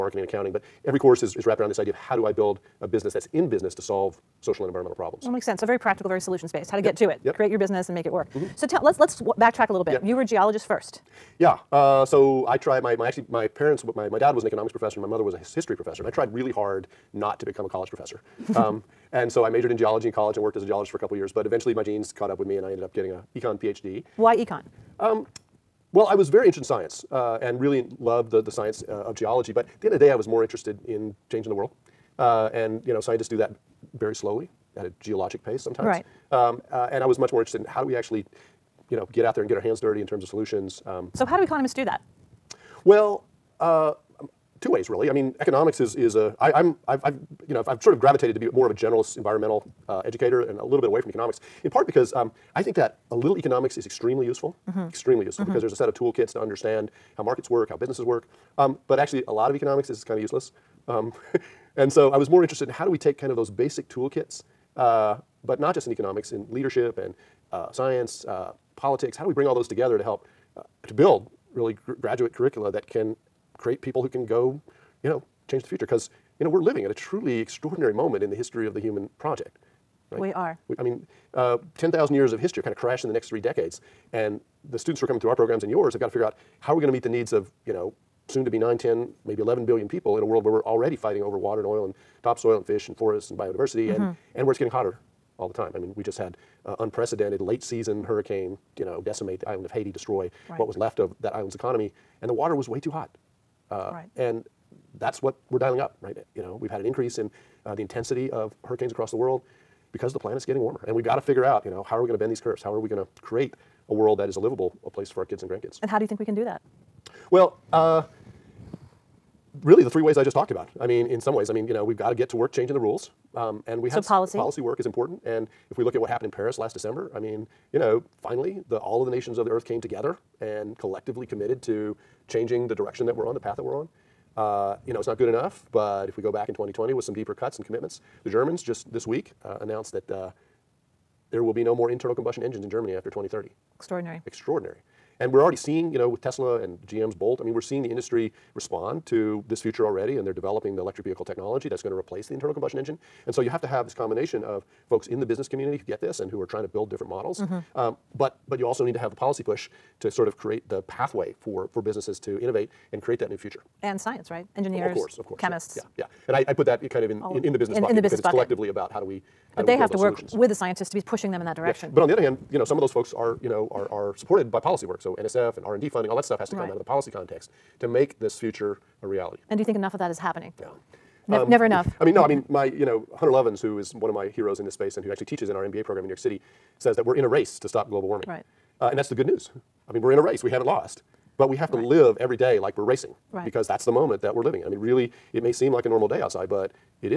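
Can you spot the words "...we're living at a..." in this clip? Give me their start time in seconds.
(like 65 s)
76 s.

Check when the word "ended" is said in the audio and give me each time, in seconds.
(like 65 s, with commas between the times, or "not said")
22 s.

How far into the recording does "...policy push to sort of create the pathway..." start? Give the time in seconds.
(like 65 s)
159 s.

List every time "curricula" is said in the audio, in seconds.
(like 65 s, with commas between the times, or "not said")
72 s.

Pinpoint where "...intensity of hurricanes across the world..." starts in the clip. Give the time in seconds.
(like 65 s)
107 s.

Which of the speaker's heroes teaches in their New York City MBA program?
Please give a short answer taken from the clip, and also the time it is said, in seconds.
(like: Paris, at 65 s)
Hunter Lovins, at 183 s.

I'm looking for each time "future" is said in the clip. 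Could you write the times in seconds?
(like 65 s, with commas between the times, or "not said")
75 s, 149 s, 163 s, 178 s.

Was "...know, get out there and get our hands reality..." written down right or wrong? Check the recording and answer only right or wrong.
wrong.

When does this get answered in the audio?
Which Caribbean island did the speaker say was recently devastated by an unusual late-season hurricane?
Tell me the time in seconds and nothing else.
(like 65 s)
99 s.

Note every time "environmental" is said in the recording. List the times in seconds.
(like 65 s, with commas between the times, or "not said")
4 s, 49 s.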